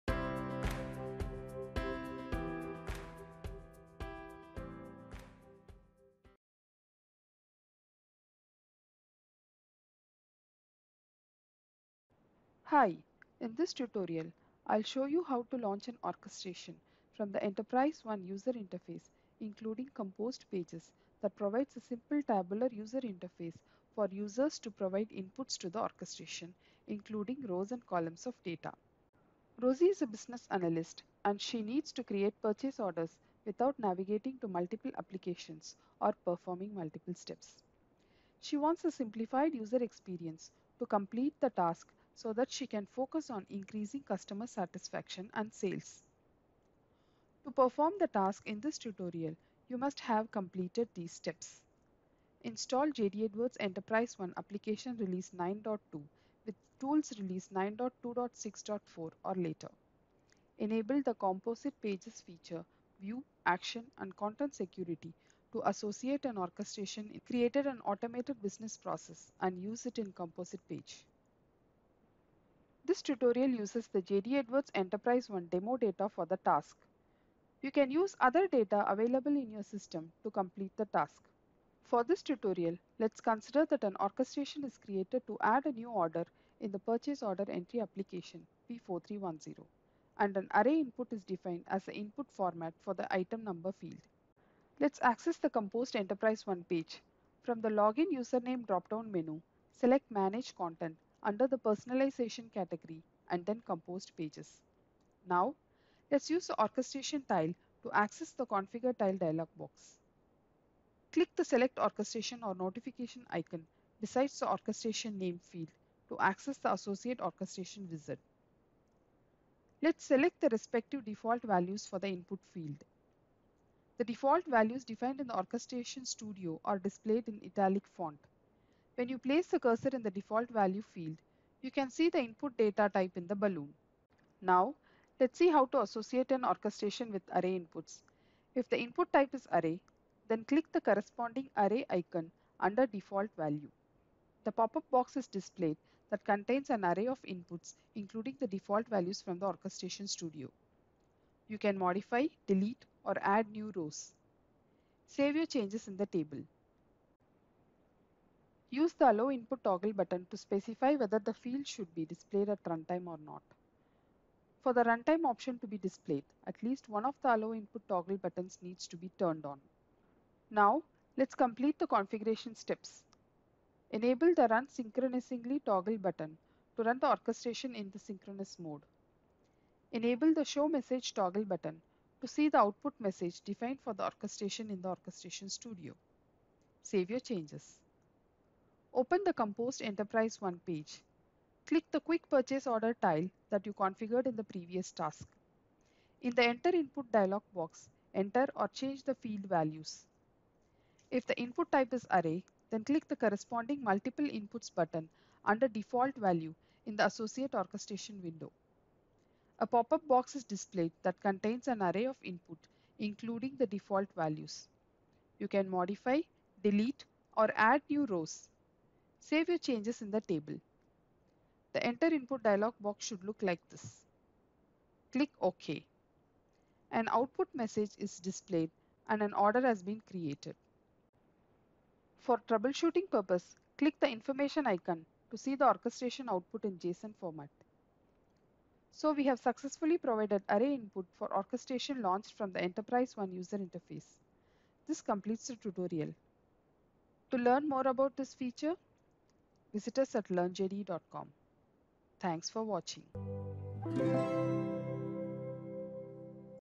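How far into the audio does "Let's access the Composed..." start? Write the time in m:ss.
1:34.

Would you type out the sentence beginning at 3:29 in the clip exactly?
A pop-up box is displayed that contains an array of input, including the default values.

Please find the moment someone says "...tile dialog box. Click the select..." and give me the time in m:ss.
1:48.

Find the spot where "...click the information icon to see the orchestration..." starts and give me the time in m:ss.
3:53.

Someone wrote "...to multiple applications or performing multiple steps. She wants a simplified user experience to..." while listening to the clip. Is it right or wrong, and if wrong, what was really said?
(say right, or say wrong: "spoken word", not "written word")
right.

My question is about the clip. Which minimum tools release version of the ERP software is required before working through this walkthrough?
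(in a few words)
9.2.6.4.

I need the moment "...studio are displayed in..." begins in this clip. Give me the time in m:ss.
2:06.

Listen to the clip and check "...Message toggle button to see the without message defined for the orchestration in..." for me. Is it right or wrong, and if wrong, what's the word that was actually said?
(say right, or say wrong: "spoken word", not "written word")
wrong: "output", not "without".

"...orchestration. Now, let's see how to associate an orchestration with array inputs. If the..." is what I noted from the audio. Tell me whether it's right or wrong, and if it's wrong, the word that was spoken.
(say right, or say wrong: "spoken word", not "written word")
wrong: "balloon", not "orchestration".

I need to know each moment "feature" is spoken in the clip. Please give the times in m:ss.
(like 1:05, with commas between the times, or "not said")
1:02, 4:08.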